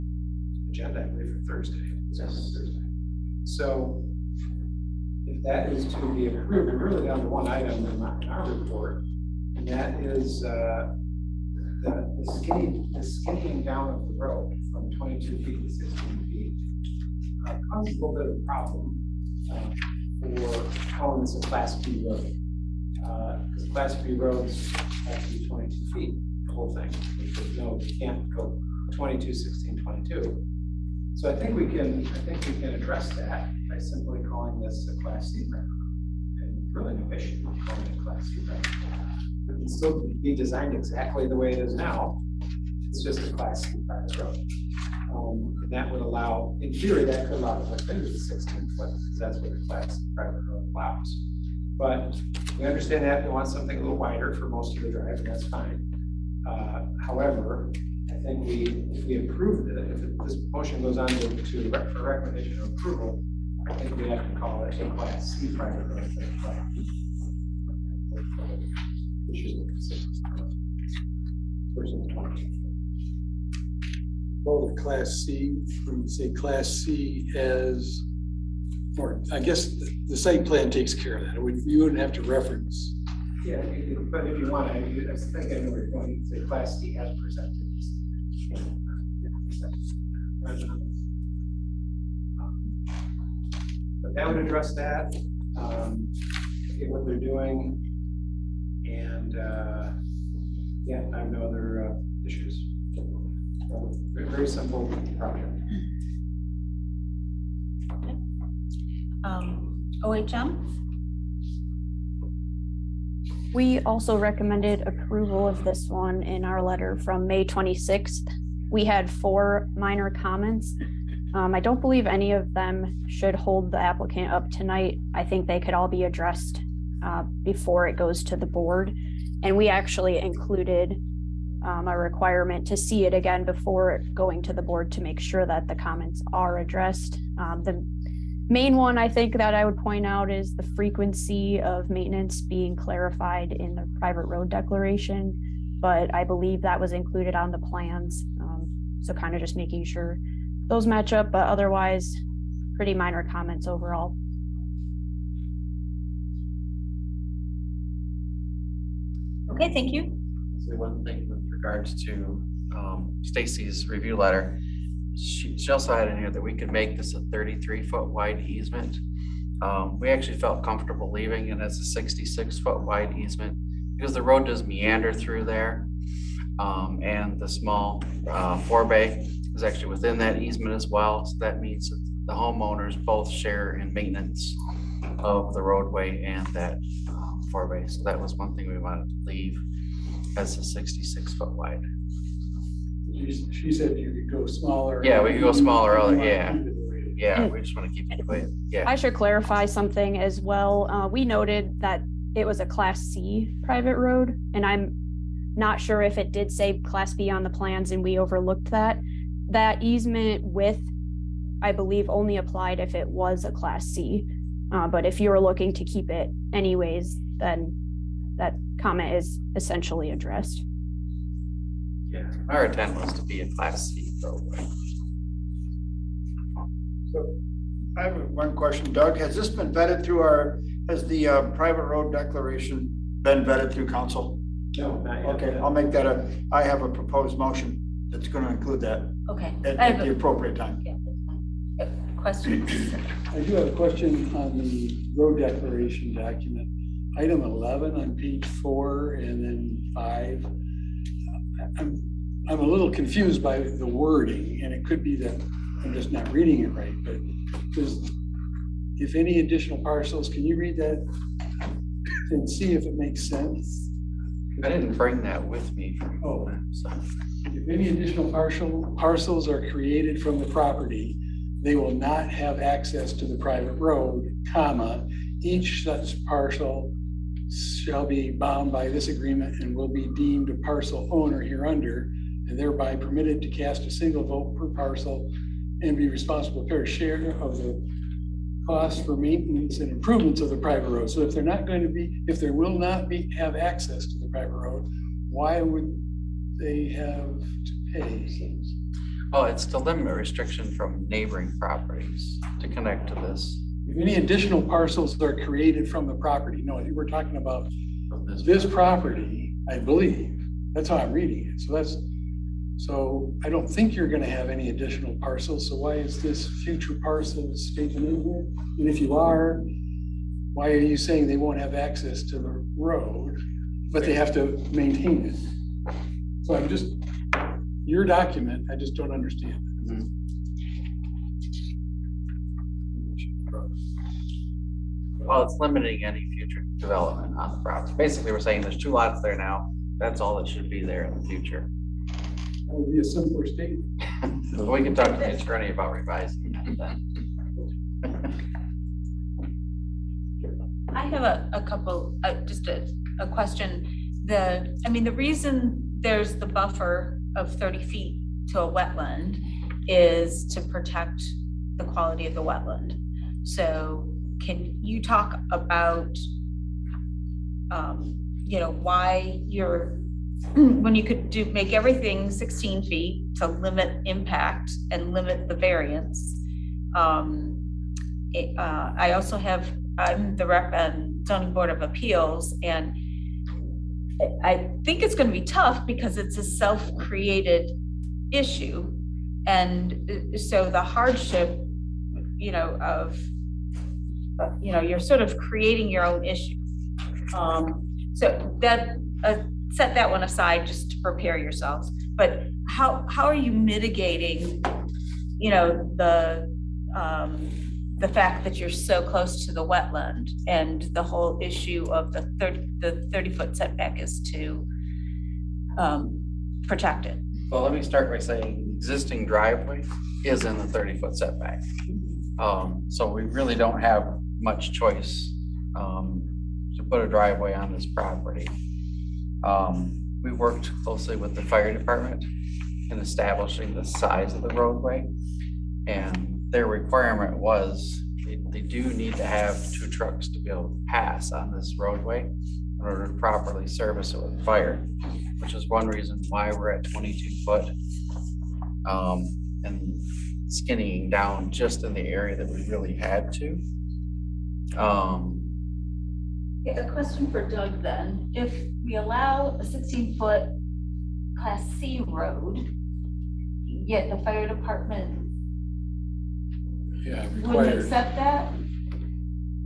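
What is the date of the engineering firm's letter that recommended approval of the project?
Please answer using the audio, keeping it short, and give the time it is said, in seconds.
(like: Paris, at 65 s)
May 26th, at 117 s.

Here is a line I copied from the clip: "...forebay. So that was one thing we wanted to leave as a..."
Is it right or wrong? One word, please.
right.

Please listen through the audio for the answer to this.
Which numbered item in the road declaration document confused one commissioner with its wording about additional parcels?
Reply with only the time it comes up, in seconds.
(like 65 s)
247 s.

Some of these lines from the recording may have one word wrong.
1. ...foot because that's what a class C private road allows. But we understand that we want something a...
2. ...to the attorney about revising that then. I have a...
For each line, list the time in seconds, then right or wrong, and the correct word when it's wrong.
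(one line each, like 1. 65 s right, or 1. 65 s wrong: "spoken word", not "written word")
1. 48 s right
2. 345 s right.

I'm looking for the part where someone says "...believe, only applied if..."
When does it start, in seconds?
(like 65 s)
211 s.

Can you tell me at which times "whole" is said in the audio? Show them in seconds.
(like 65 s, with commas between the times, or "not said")
26 s, 411 s.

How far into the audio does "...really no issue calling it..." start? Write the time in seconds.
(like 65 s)
36 s.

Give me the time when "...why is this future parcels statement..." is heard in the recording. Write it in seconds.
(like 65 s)
315 s.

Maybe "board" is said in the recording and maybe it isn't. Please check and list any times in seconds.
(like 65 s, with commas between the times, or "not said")
128 s, 134 s, 381 s.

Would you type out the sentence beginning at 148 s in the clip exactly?
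Um, so kind of just making sure those match up, but otherwise pretty minor comments overall.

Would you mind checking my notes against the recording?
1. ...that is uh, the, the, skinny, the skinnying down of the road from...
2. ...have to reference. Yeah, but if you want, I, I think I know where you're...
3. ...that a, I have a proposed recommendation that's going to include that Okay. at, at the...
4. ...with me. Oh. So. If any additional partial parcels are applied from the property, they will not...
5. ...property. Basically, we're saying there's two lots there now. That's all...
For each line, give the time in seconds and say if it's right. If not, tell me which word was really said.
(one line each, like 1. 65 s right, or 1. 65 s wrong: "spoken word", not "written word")
1. 9 s right
2. 81 s right
3. 235 s wrong: "motion", not "recommendation"
4. 265 s wrong: "created", not "applied"
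5. 337 s right.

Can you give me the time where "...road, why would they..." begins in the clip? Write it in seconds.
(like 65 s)
294 s.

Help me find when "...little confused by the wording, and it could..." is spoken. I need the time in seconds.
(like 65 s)
252 s.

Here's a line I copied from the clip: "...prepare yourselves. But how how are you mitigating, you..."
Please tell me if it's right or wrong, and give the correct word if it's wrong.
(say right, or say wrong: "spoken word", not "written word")
right.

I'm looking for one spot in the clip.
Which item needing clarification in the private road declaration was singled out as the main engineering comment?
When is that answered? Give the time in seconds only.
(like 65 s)
140 s.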